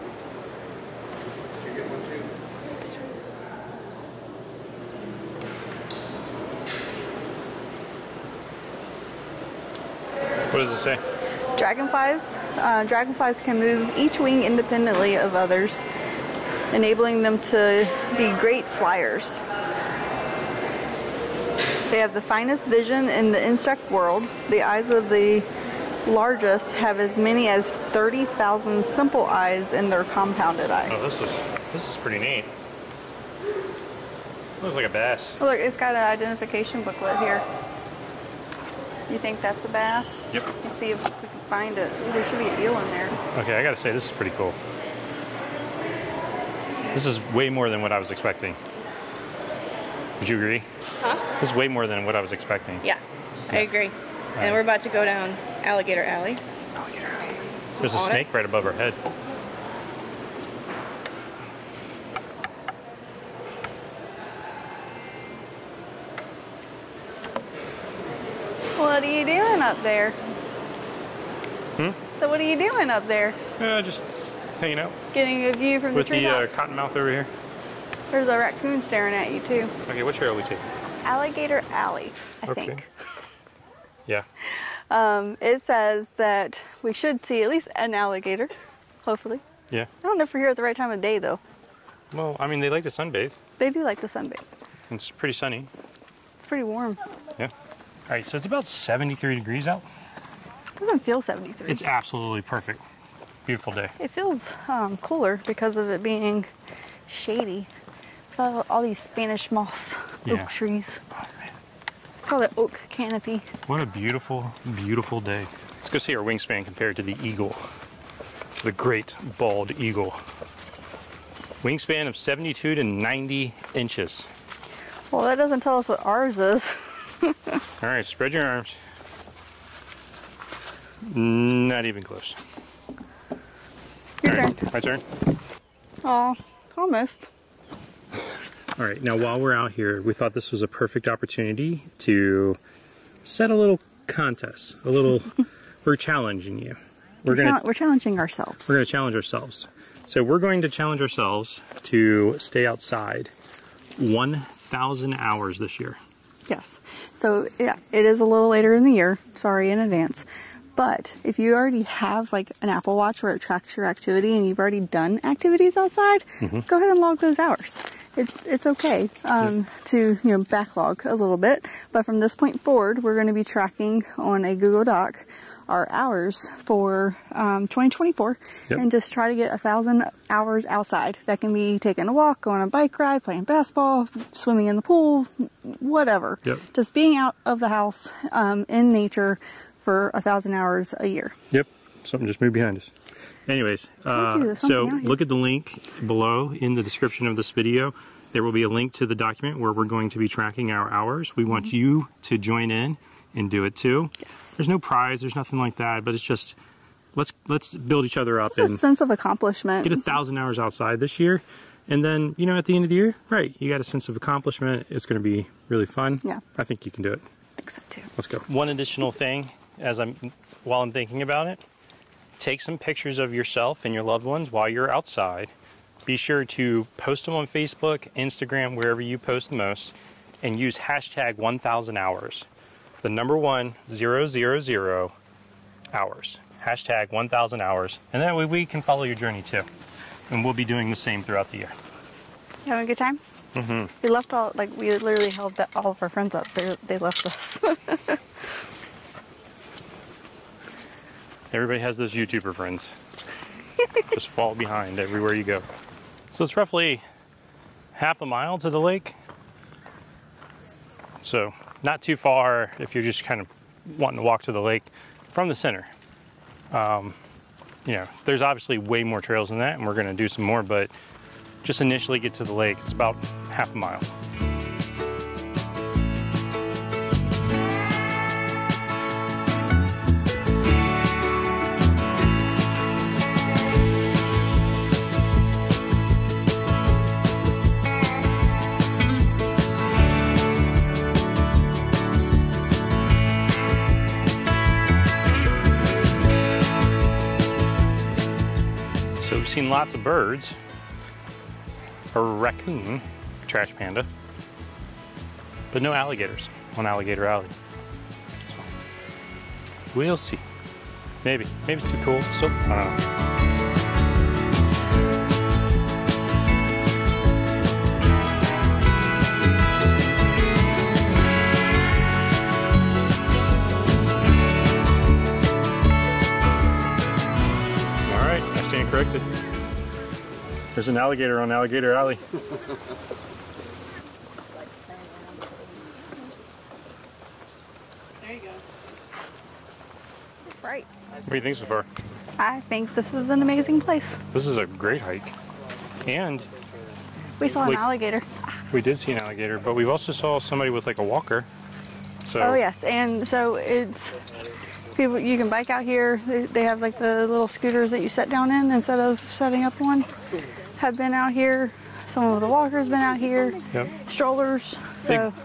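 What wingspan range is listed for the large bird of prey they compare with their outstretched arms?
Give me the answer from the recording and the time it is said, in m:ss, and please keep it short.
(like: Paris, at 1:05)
72 to 90 inches, at 2:02.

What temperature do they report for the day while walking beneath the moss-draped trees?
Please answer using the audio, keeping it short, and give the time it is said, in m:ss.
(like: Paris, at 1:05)
73 degrees, at 1:38.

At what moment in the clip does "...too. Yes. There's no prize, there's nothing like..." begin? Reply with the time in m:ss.
3:23.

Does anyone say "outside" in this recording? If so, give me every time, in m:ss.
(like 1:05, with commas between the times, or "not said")
2:32, 2:45, 3:00, 3:30, 3:44.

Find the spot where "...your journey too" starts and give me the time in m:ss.
3:59.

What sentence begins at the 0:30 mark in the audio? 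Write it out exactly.
Oh, this is, this is pretty neat.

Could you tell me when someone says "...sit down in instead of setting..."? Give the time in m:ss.
5:58.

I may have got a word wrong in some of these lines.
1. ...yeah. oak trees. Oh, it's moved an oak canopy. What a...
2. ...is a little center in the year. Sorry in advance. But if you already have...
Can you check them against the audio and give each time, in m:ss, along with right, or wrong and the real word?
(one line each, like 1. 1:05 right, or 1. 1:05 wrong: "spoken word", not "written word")
1. 1:50 wrong: "called", not "moved"
2. 2:38 wrong: "later", not "center".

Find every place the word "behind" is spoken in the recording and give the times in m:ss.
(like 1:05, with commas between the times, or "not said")
3:12, 4:14.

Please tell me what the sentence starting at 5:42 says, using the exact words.
I think this is an amazing place.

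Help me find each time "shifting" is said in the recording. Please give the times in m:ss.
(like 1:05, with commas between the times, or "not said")
not said.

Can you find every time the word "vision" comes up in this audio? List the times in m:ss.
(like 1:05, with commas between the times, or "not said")
0:22.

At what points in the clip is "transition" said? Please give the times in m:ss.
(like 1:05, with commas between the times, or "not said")
not said.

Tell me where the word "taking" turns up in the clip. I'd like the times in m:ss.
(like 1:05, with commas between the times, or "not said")
1:20, 3:01.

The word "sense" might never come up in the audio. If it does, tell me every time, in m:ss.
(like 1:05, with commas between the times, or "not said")
3:28, 3:33.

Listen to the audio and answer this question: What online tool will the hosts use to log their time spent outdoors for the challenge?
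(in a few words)
Google Doc.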